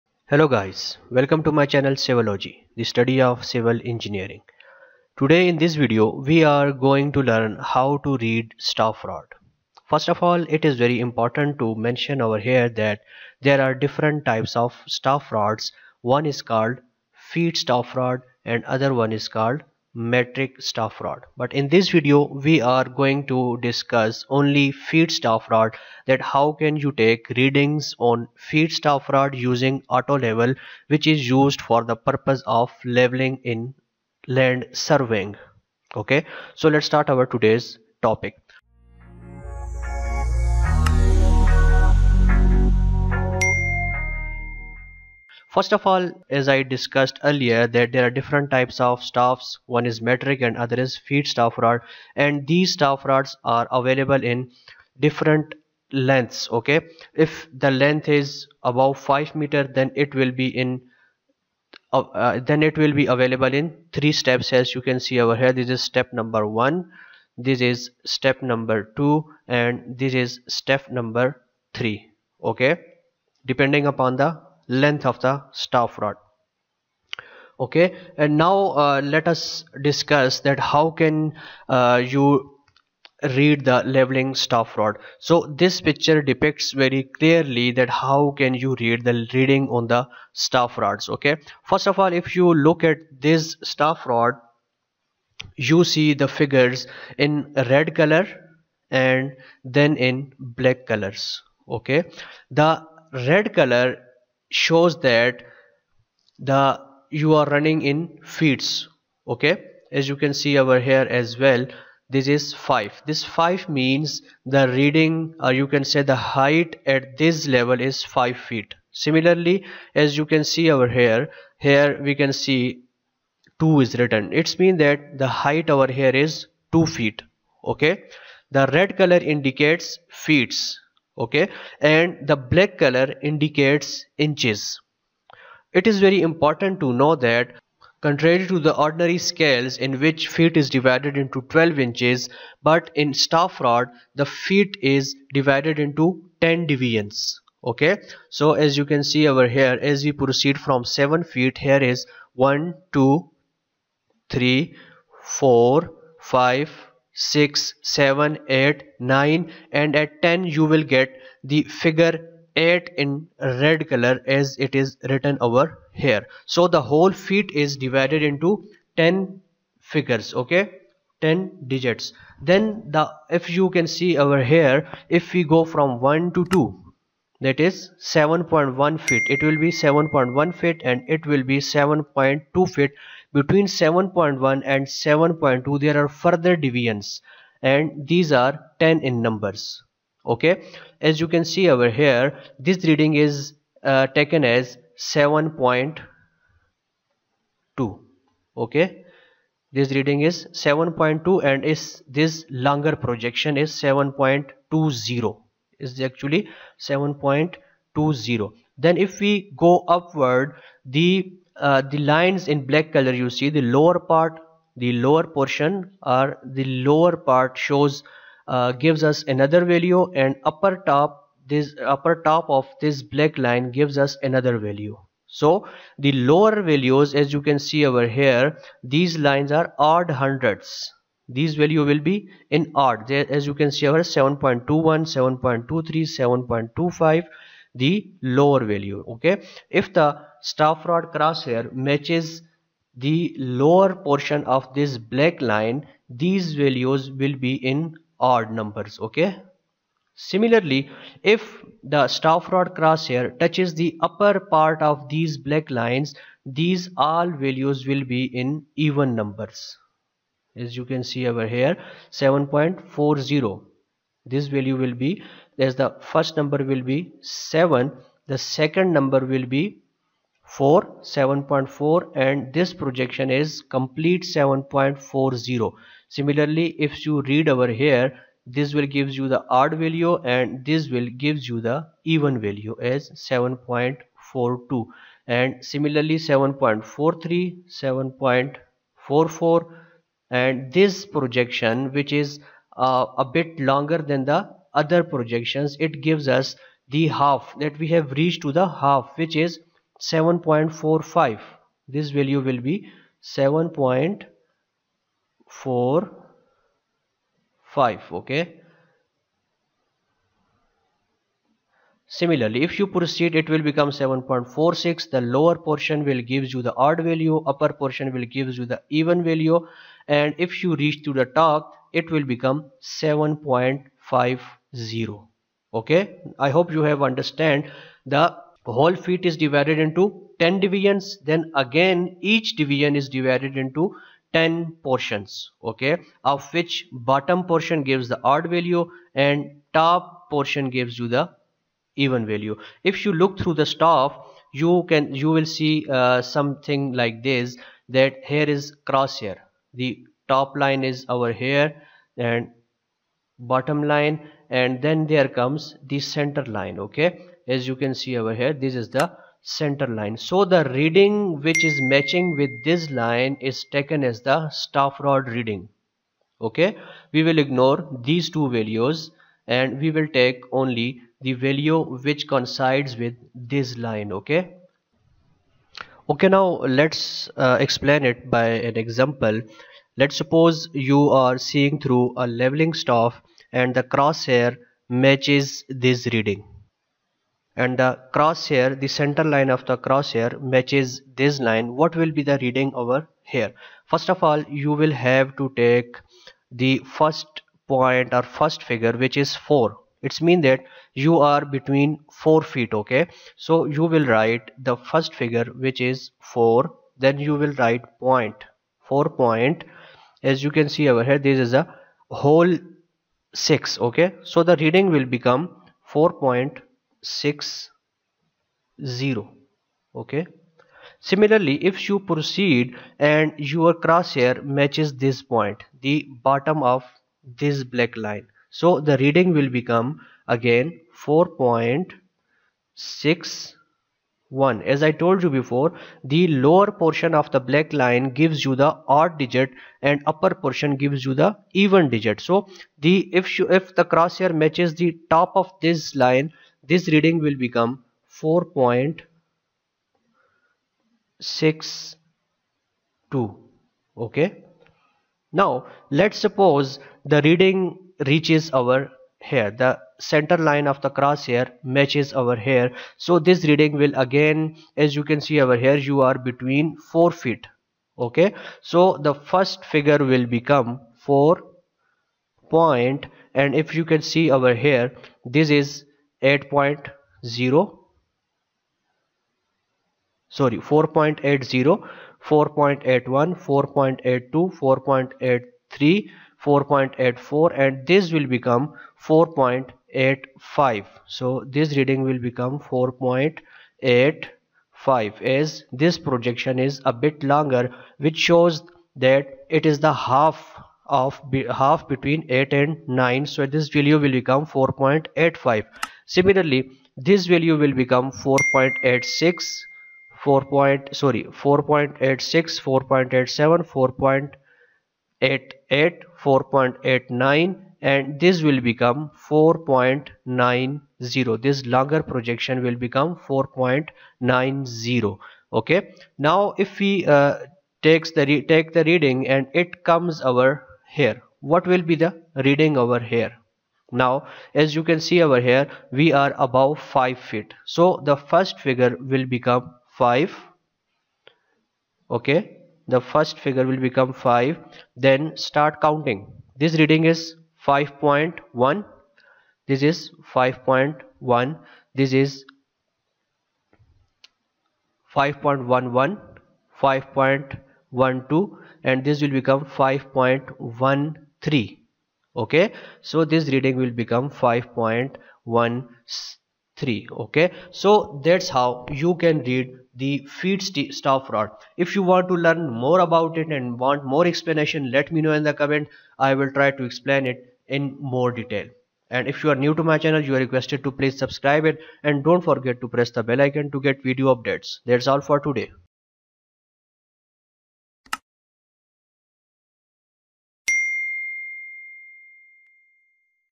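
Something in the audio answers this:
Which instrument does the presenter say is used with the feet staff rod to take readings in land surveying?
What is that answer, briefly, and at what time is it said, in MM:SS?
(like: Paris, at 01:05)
Auto level, at 00:29.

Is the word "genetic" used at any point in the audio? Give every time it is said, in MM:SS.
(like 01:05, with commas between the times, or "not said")
not said.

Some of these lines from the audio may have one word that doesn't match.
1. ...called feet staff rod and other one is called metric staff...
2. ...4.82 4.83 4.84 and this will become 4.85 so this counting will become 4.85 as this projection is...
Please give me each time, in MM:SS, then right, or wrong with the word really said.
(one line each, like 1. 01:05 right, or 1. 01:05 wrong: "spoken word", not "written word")
1. 00:16 right
2. 08:03 wrong: "reading", not "counting".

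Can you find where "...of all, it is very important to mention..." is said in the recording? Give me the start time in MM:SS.
00:10.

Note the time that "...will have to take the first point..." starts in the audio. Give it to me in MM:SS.
06:34.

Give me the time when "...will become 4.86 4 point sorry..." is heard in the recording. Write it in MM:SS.
08:27.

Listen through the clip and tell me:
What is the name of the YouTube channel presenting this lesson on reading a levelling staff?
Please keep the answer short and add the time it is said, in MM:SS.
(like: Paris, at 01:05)
Civillogy, at 00:01.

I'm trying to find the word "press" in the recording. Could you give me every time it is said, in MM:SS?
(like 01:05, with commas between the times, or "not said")
09:42.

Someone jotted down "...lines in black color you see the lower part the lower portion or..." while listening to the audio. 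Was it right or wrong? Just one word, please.
right.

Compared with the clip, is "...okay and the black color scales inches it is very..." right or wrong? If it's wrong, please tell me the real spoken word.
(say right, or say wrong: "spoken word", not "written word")
wrong: "indicates", not "scales".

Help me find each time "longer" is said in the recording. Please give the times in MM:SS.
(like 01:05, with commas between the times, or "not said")
03:22, 04:53, 08:17, 08:41.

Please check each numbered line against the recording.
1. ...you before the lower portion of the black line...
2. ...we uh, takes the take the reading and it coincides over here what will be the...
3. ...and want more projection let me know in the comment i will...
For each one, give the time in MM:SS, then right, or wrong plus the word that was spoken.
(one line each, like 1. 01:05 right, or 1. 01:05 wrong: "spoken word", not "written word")
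1. 07:15 right
2. 08:46 wrong: "comes", not "coincides"
3. 09:33 wrong: "explanation", not "projection".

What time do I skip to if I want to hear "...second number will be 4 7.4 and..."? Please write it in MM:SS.
04:28.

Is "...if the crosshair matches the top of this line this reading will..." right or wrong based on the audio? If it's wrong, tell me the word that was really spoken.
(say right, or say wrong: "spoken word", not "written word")
right.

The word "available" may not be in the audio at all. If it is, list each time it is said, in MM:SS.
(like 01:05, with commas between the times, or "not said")
00:53, 01:03.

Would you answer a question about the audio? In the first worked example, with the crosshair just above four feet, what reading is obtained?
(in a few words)
4.60.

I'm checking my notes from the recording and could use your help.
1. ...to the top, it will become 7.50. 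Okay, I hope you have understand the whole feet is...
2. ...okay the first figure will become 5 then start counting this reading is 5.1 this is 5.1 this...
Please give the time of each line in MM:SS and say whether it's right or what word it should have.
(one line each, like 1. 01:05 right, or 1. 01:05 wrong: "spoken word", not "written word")
1. 05:21 right
2. 09:02 right.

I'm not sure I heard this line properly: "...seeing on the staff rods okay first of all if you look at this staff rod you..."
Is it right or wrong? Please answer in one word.
wrong.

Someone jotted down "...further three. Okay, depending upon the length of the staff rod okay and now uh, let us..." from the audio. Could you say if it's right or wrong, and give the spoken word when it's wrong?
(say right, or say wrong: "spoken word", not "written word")
wrong: "number", not "further".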